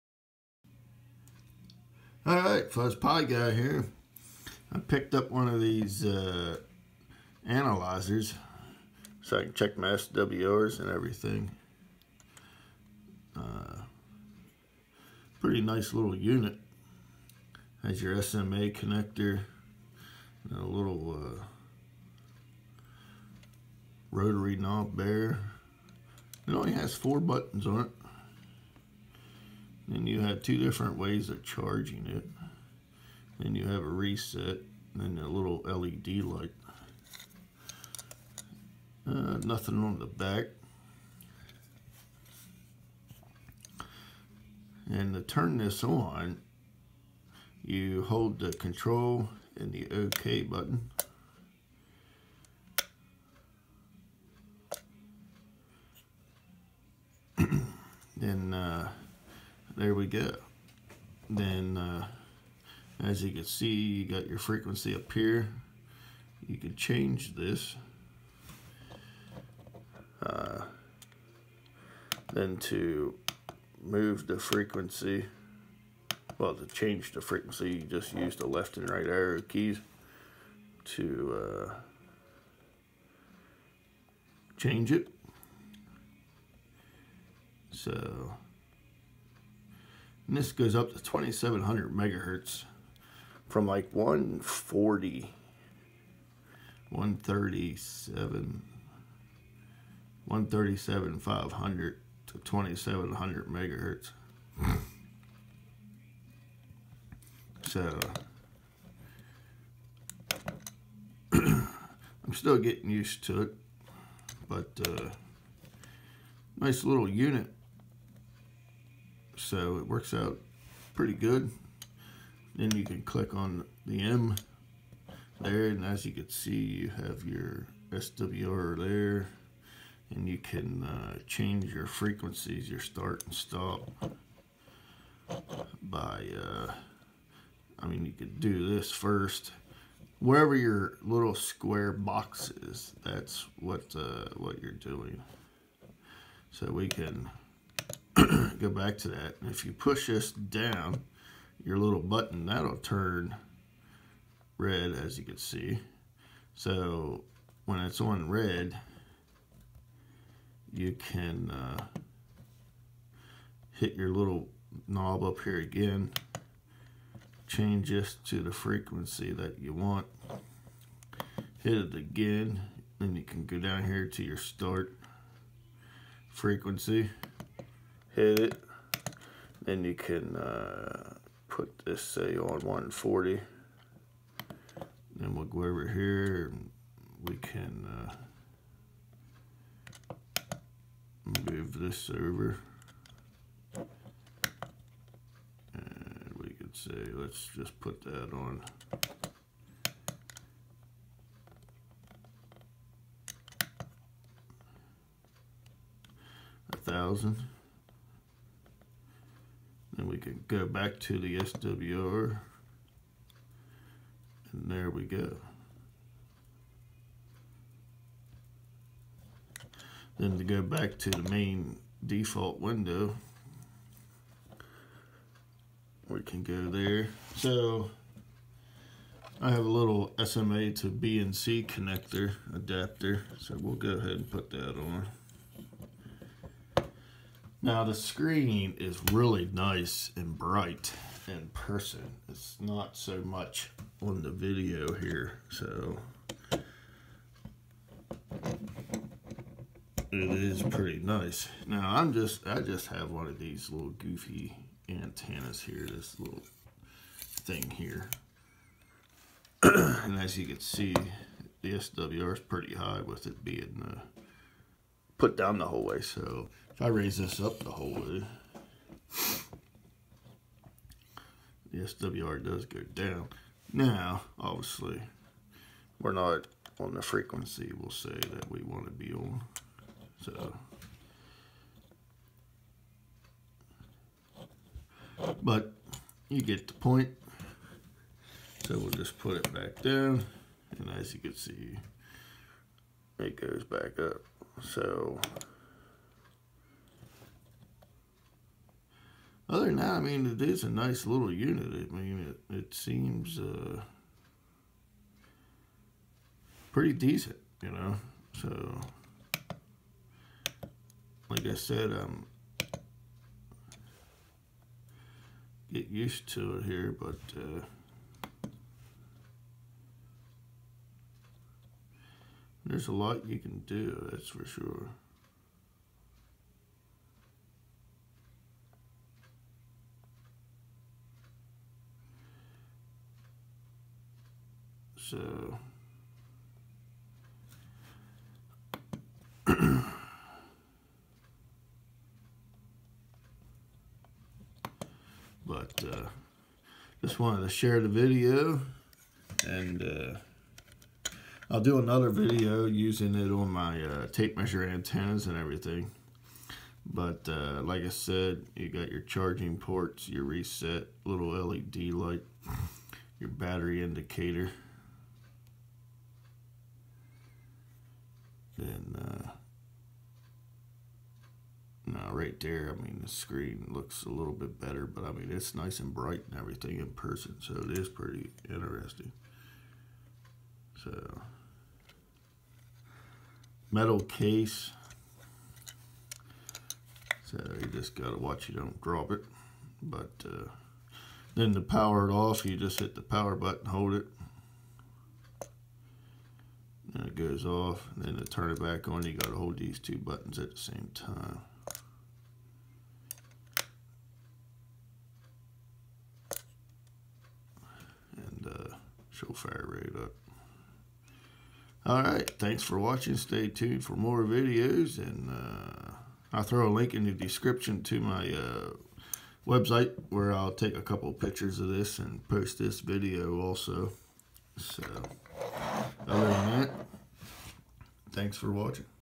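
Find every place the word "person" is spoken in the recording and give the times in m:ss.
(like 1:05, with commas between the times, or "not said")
4:01, 6:16.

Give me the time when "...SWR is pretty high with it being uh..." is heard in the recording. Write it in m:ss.
4:21.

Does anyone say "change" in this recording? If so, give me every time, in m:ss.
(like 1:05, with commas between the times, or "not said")
1:06, 1:16, 1:24, 2:11, 2:47.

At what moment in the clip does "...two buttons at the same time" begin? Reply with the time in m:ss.
6:39.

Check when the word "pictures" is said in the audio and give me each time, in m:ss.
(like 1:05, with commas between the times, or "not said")
7:01.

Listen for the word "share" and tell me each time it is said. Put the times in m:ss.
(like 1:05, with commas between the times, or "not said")
5:47.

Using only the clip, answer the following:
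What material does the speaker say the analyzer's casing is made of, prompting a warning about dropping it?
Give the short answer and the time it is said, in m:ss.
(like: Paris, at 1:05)
Metal, at 6:23.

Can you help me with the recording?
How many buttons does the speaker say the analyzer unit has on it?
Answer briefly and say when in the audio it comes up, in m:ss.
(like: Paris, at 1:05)
4, at 0:26.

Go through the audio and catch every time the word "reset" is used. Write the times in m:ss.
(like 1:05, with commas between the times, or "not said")
0:33, 6:00.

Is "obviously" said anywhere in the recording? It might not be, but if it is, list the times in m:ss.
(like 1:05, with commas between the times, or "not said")
4:34.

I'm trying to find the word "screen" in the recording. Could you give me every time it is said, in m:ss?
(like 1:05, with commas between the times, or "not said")
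3:57, 6:13.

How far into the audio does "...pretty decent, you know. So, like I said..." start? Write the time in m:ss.
5:06.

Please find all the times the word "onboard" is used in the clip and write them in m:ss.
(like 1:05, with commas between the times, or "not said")
not said.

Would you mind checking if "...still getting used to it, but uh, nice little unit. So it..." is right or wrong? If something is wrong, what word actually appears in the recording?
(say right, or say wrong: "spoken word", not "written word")
right.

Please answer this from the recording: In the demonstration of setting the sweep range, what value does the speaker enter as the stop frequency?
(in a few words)
1000.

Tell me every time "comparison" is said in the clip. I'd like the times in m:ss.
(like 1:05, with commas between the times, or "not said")
not said.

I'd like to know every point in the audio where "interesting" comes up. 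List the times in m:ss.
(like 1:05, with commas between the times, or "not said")
6:18.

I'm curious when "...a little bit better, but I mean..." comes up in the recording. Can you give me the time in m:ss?
6:14.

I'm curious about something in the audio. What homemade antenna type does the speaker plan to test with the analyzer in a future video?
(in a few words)
Tape measure antennas.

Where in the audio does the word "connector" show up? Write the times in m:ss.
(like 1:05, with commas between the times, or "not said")
0:18, 3:51.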